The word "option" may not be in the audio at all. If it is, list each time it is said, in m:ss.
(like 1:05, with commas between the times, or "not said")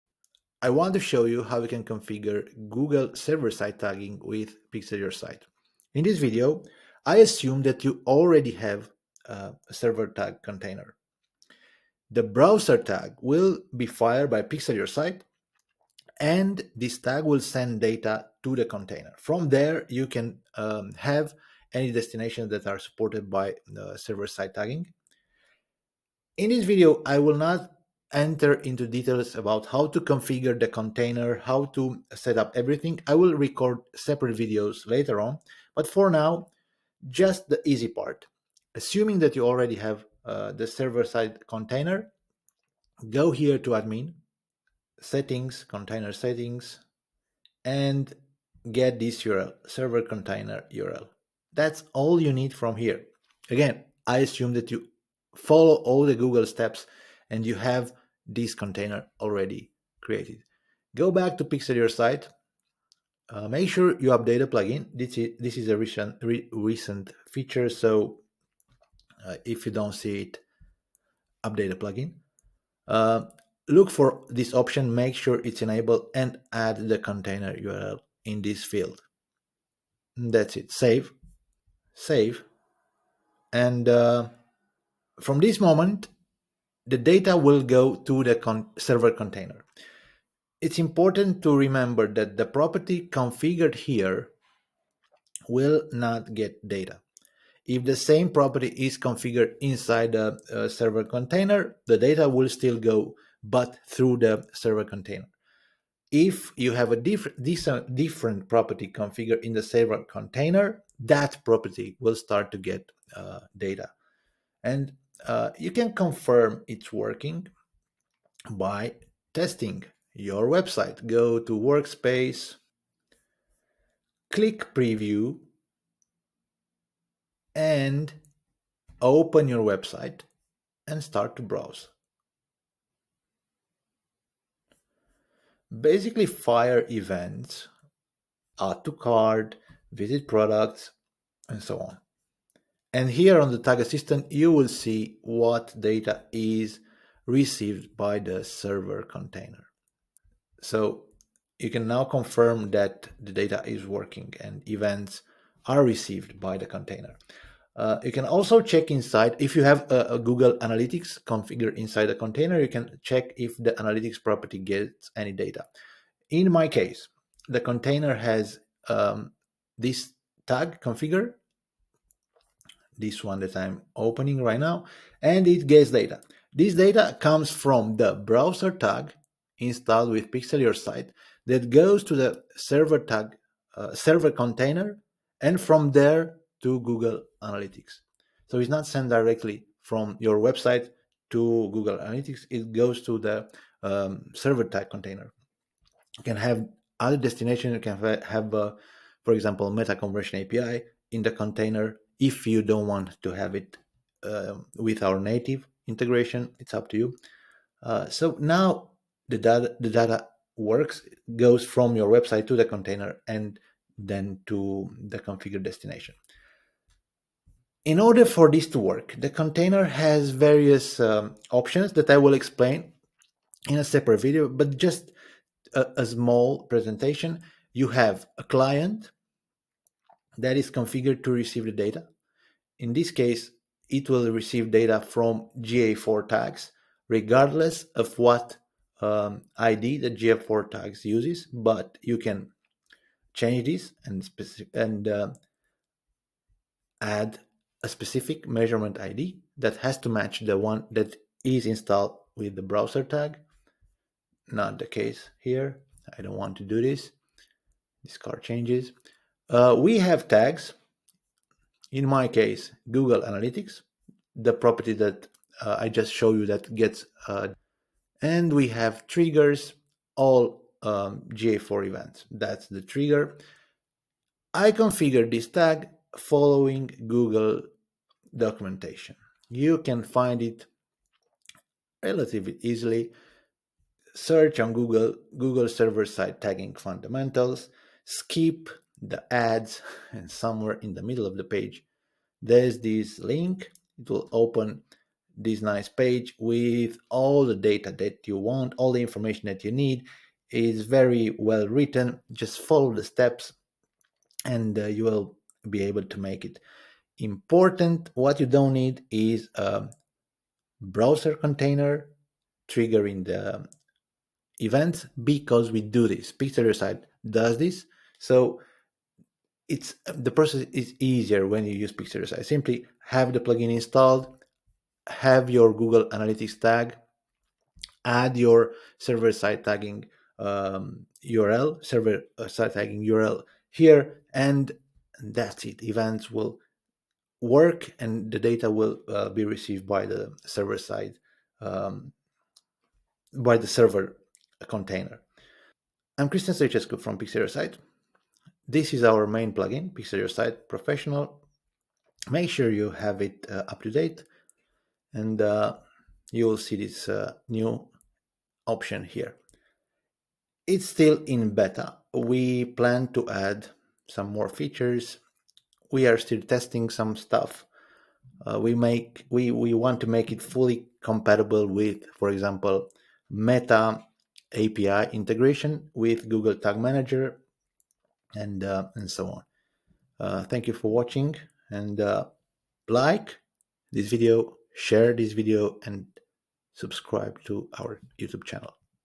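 1:14, 3:41, 5:58.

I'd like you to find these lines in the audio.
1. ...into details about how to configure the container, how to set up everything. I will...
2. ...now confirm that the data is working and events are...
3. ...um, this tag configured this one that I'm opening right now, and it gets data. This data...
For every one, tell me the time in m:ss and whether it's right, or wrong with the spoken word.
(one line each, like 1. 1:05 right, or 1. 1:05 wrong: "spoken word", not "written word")
1. 0:28 right
2. 2:31 right
3. 2:48 right.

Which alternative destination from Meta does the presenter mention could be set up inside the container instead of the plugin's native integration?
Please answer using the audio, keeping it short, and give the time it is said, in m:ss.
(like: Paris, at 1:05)
Meta Conversion API, at 3:19.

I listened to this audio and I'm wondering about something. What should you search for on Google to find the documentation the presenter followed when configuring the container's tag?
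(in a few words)
Google server side tagging fundamentals.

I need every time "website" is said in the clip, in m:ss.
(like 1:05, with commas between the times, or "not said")
2:00, 2:09, 3:10, 3:32.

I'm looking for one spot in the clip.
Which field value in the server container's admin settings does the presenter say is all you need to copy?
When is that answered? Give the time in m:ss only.
0:49.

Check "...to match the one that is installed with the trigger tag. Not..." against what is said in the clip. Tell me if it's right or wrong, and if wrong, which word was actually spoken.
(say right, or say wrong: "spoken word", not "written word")
wrong: "browser", not "trigger".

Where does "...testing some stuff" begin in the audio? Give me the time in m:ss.
6:06.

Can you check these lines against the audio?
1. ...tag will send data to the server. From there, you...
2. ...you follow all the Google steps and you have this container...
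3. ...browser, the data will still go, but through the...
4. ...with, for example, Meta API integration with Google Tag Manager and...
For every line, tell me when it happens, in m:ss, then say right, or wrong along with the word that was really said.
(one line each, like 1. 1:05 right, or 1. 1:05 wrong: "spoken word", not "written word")
1. 0:16 wrong: "container", not "server"
2. 0:54 right
3. 1:41 wrong: "container", not "browser"
4. 6:11 right.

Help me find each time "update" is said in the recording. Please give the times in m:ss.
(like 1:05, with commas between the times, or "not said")
1:04, 1:11.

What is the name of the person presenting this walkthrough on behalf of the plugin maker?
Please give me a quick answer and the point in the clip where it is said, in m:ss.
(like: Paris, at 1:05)
Cristian Sechescu, at 5:46.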